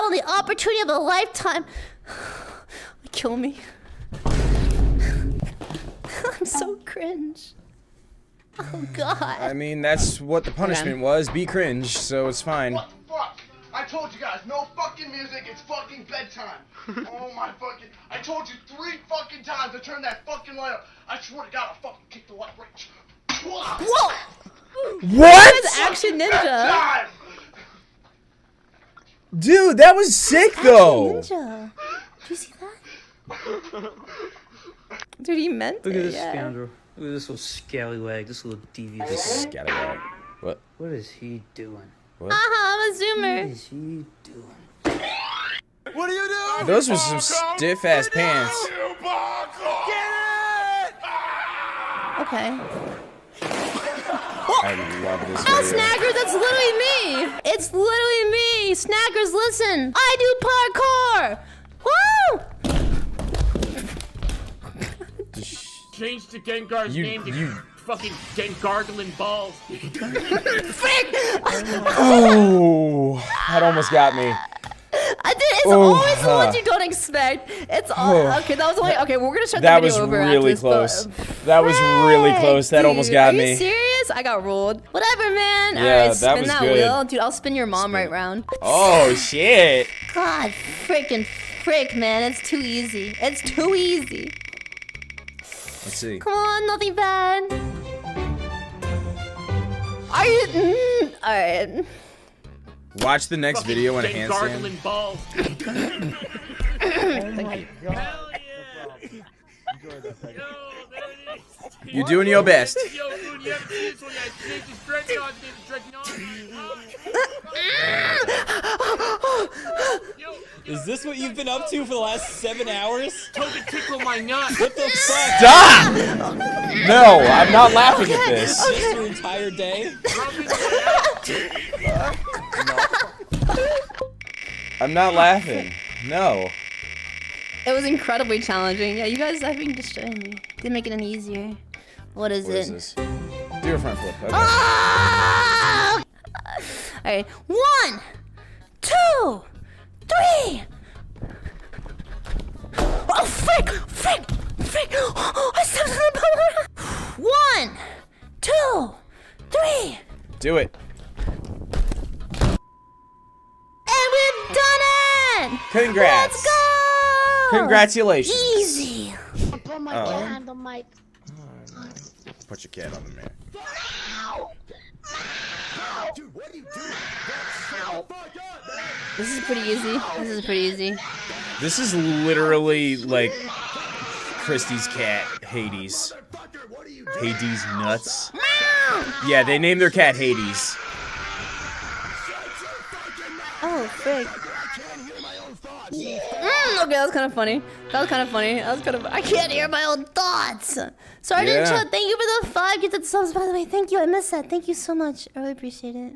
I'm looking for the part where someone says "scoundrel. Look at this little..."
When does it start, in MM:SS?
00:36.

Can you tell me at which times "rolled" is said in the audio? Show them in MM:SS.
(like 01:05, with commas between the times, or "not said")
01:24.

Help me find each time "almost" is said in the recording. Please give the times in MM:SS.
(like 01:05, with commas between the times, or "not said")
01:13, 01:22.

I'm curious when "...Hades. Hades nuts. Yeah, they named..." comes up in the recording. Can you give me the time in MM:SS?
03:05.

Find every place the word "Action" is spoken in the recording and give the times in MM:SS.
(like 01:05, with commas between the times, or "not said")
00:25, 00:30.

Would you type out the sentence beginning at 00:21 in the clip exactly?
I swear to God, I'll fucking kick the light right.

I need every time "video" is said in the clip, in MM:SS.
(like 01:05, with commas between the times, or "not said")
00:55, 01:19, 01:43.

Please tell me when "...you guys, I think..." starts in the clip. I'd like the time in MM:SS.
02:19.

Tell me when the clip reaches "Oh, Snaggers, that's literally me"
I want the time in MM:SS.
00:55.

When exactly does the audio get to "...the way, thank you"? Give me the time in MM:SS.
03:23.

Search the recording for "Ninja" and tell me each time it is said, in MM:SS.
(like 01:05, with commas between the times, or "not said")
00:26, 00:31.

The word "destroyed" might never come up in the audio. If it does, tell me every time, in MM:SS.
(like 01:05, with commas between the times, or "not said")
02:19.